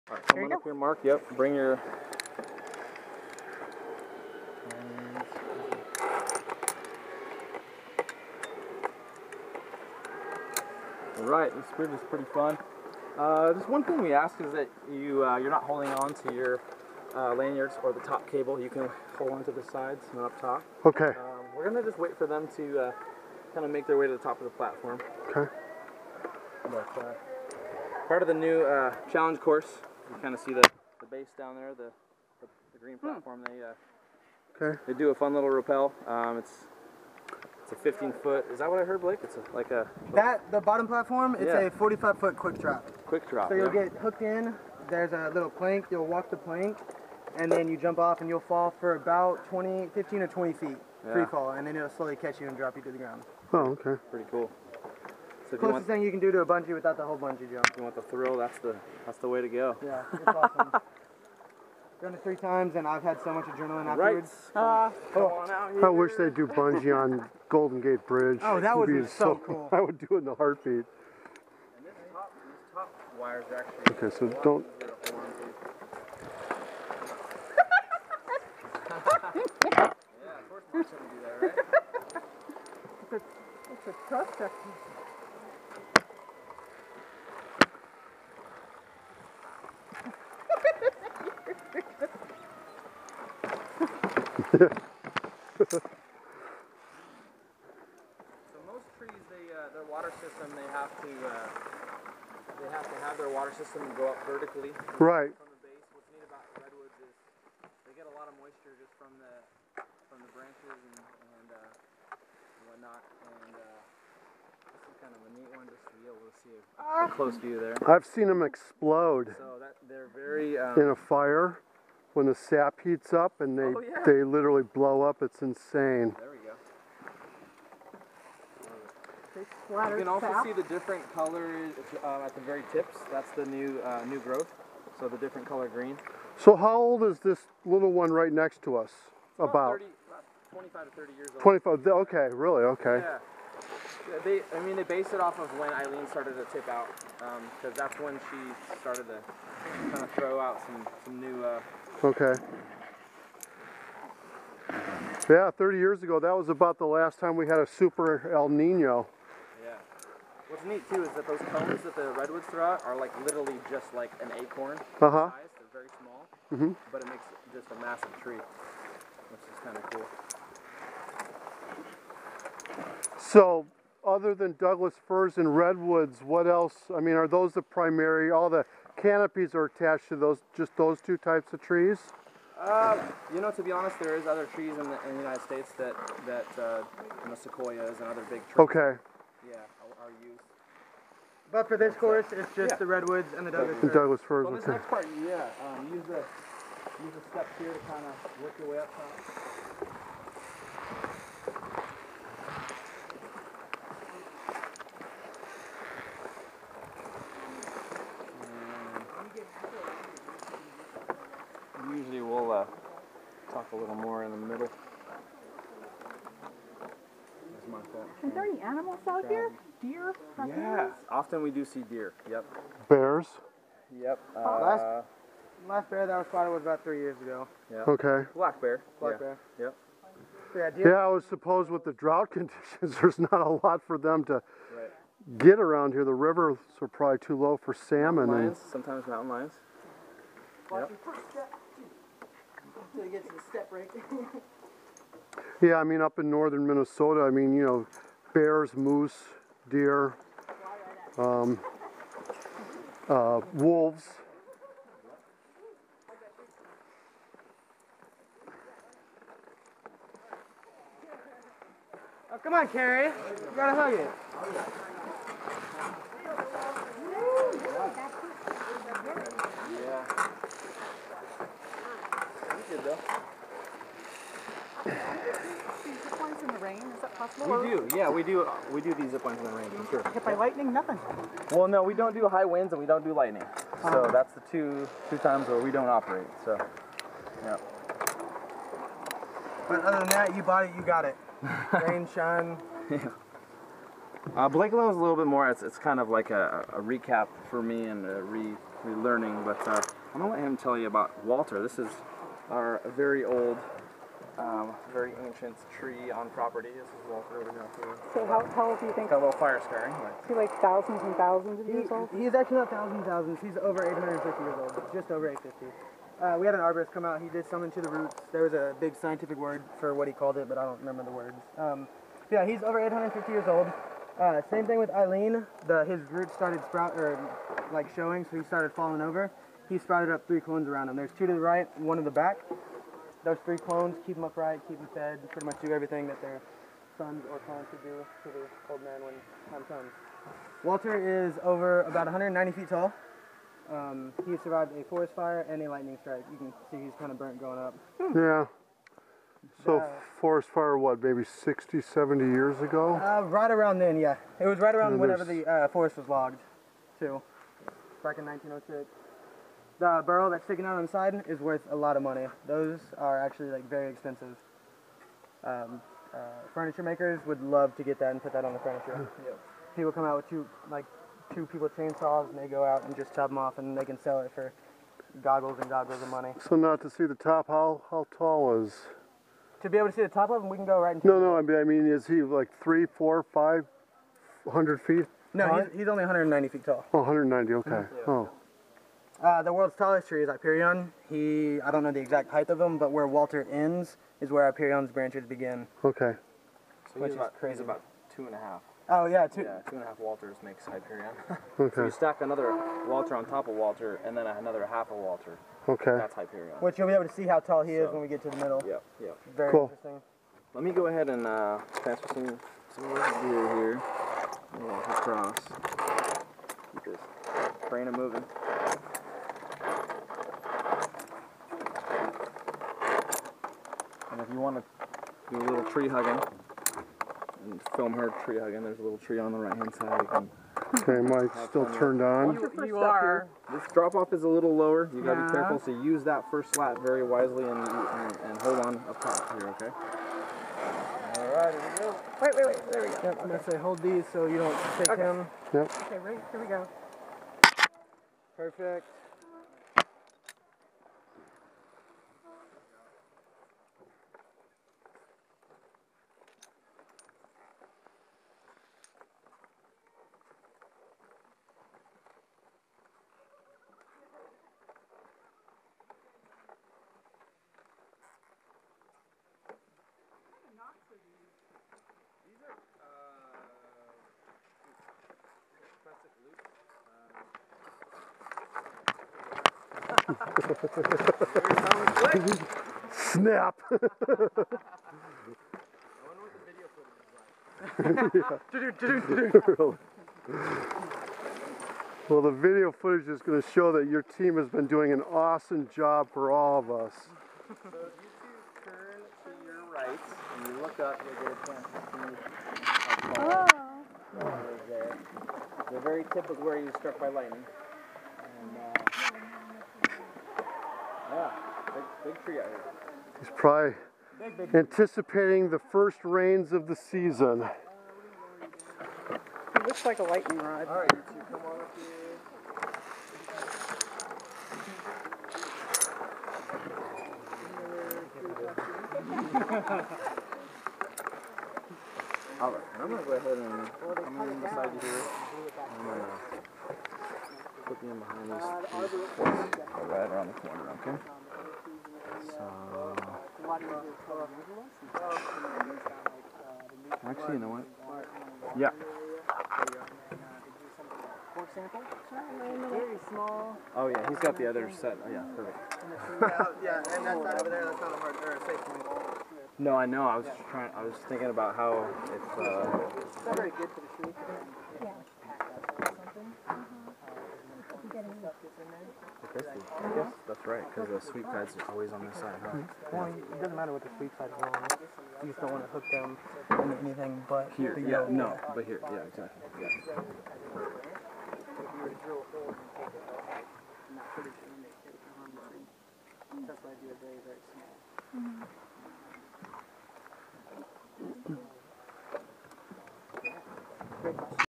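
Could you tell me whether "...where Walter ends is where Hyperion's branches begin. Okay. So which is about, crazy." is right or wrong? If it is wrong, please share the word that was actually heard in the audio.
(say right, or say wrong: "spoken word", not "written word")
right.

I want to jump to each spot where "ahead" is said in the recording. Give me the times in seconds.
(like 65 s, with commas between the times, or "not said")
410 s, 533 s.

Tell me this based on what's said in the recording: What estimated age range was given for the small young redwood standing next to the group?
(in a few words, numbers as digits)
25 to 30 years.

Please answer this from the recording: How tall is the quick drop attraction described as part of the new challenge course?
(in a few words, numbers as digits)
45 feet.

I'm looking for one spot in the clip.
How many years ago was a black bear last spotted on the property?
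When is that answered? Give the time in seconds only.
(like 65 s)
226 s.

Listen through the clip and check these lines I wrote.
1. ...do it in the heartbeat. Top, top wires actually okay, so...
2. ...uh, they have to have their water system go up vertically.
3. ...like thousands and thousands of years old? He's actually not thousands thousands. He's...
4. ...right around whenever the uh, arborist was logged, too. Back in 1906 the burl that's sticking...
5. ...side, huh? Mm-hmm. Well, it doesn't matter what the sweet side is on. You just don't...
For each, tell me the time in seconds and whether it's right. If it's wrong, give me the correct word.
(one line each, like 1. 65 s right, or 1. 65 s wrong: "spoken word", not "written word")
1. 69 s right
2. 101 s right
3. 310 s right
4. 354 s wrong: "forest", not "arborist"
5. 572 s right.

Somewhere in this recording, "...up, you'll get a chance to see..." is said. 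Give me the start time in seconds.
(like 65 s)
500 s.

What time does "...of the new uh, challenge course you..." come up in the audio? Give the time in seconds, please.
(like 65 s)
28 s.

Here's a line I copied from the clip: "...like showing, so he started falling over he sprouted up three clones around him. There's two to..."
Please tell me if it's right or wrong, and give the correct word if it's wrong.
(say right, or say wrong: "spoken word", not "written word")
right.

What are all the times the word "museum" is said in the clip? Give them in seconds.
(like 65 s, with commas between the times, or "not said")
not said.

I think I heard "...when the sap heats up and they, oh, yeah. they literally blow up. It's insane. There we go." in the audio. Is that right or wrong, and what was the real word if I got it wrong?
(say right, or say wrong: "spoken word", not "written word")
right.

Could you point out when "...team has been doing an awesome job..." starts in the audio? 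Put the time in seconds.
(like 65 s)
494 s.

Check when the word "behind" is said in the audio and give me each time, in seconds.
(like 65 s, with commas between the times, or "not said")
537 s.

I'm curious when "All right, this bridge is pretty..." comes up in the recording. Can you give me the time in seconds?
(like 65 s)
11 s.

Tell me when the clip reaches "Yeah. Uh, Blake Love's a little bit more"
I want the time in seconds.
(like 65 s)
292 s.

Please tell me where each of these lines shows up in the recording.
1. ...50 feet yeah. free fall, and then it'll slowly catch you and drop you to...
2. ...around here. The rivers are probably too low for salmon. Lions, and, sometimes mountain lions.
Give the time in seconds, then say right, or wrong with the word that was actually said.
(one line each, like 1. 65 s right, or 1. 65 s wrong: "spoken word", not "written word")
1. 50 s wrong: "20", not "50"
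2. 235 s right.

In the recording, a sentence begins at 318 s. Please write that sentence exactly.
There was a big scientific word for what he called it, but I don't remember the words.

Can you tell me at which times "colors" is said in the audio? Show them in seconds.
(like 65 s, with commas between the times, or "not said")
131 s, 135 s.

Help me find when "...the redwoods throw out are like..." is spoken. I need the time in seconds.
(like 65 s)
161 s.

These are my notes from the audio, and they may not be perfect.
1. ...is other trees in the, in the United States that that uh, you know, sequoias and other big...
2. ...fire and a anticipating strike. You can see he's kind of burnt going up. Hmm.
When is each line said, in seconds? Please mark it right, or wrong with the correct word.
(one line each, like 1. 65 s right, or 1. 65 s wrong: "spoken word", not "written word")
1. 184 s right
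2. 345 s wrong: "lightning", not "anticipating".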